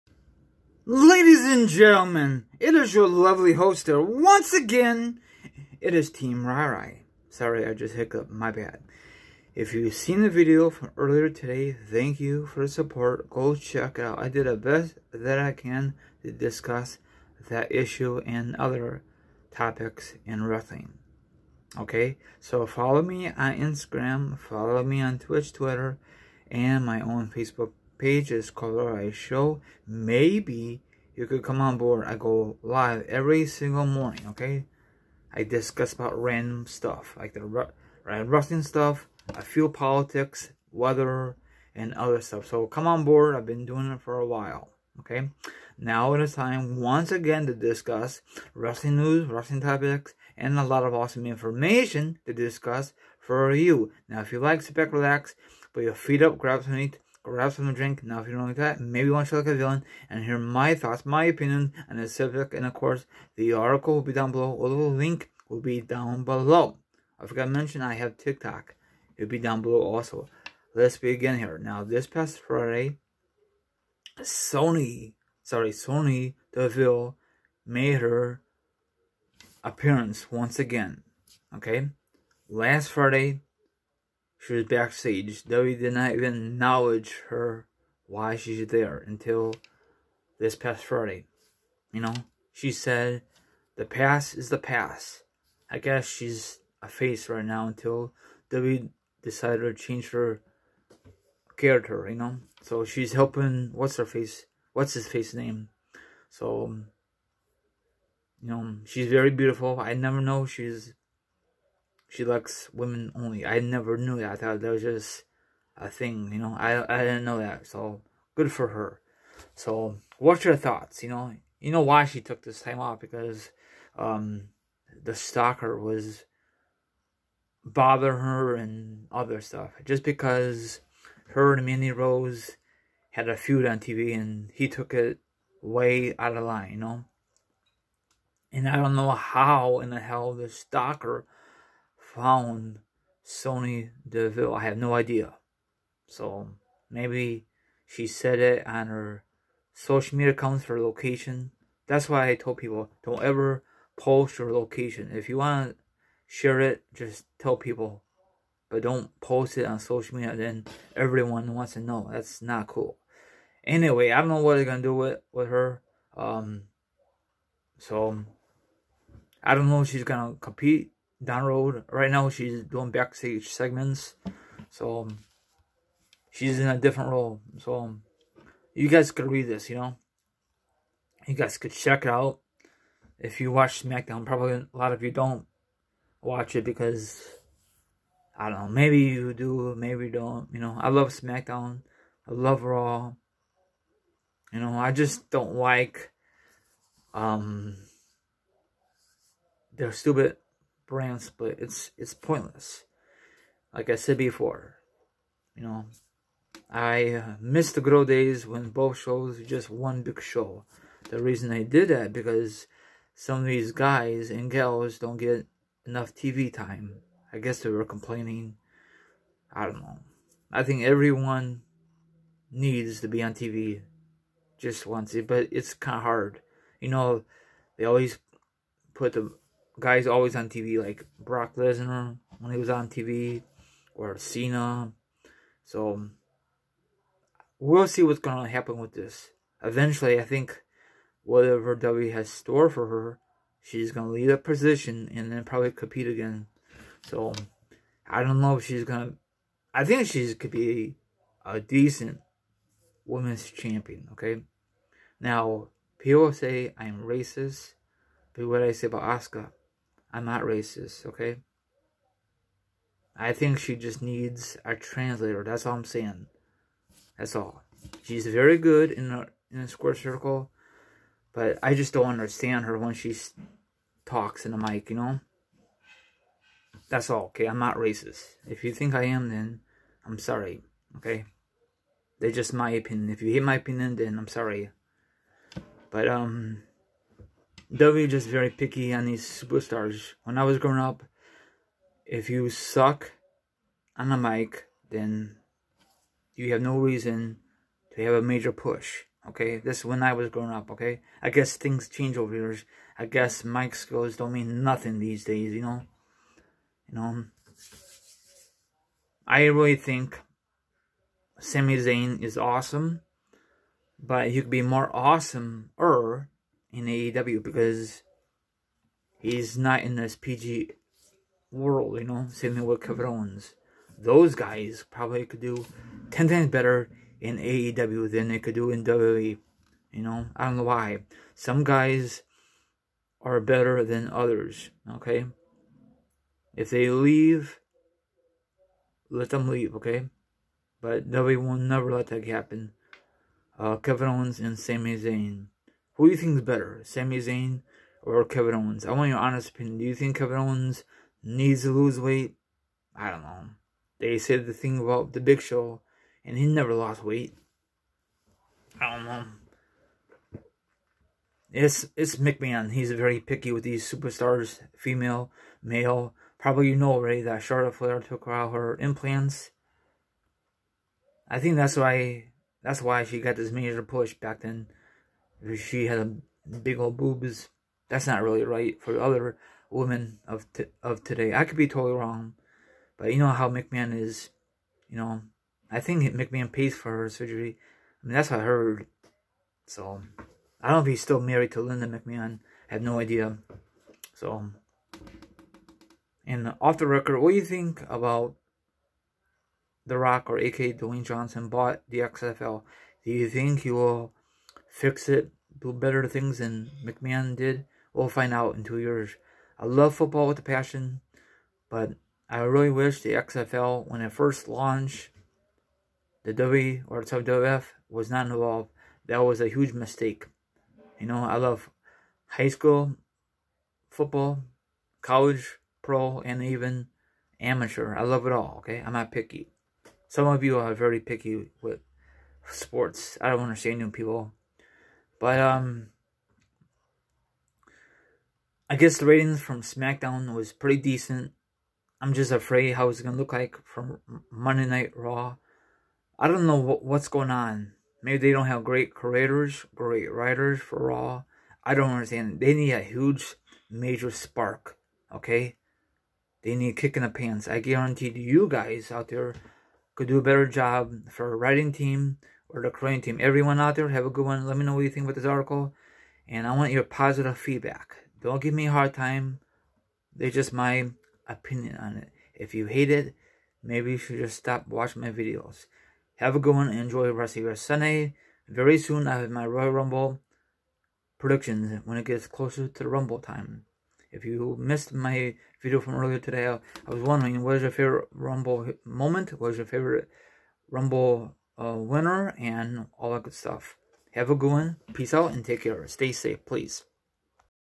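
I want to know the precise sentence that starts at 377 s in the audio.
That's not really right for other women of of today.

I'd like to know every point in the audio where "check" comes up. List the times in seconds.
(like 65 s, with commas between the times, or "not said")
13 s, 181 s.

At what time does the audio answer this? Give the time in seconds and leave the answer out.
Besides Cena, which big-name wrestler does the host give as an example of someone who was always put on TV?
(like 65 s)
231 s.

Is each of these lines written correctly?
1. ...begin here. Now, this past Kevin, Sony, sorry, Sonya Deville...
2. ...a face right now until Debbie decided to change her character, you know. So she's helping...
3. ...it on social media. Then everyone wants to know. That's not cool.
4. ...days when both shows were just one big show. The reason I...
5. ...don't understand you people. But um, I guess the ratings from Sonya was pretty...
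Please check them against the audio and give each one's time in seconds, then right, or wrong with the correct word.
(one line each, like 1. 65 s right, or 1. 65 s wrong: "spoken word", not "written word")
1. 70 s wrong: "Friday", not "Kevin"
2. 96 s right
3. 159 s right
4. 208 s right
5. 433 s wrong: "SmackDown", not "Sonya".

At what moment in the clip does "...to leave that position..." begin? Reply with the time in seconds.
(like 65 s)
244 s.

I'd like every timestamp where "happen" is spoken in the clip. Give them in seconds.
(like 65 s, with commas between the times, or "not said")
238 s, 342 s.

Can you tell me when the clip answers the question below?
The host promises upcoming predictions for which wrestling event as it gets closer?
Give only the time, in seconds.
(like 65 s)
479 s.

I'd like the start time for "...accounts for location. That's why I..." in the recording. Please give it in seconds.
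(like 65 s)
150 s.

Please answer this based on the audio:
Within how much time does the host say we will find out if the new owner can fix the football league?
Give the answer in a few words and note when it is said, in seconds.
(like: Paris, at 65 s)
2 years, at 408 s.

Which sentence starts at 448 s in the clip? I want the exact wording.
Maybe they don't have great creators, great writers for Raw.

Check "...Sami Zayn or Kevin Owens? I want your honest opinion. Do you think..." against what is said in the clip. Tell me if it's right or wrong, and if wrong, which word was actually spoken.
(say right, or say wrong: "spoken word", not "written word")
right.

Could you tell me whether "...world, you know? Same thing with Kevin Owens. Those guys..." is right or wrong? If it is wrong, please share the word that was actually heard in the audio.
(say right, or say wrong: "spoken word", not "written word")
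right.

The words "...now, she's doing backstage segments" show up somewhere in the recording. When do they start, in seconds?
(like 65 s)
172 s.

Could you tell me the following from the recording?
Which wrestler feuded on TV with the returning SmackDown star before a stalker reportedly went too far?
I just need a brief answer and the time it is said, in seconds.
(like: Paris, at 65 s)
Mandy Rose, at 131 s.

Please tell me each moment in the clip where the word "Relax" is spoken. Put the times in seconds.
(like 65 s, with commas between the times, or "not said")
54 s.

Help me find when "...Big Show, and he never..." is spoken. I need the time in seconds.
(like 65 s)
355 s.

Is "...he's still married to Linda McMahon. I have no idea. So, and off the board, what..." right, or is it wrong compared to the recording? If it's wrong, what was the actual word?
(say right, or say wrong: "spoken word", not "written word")
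wrong: "record", not "board".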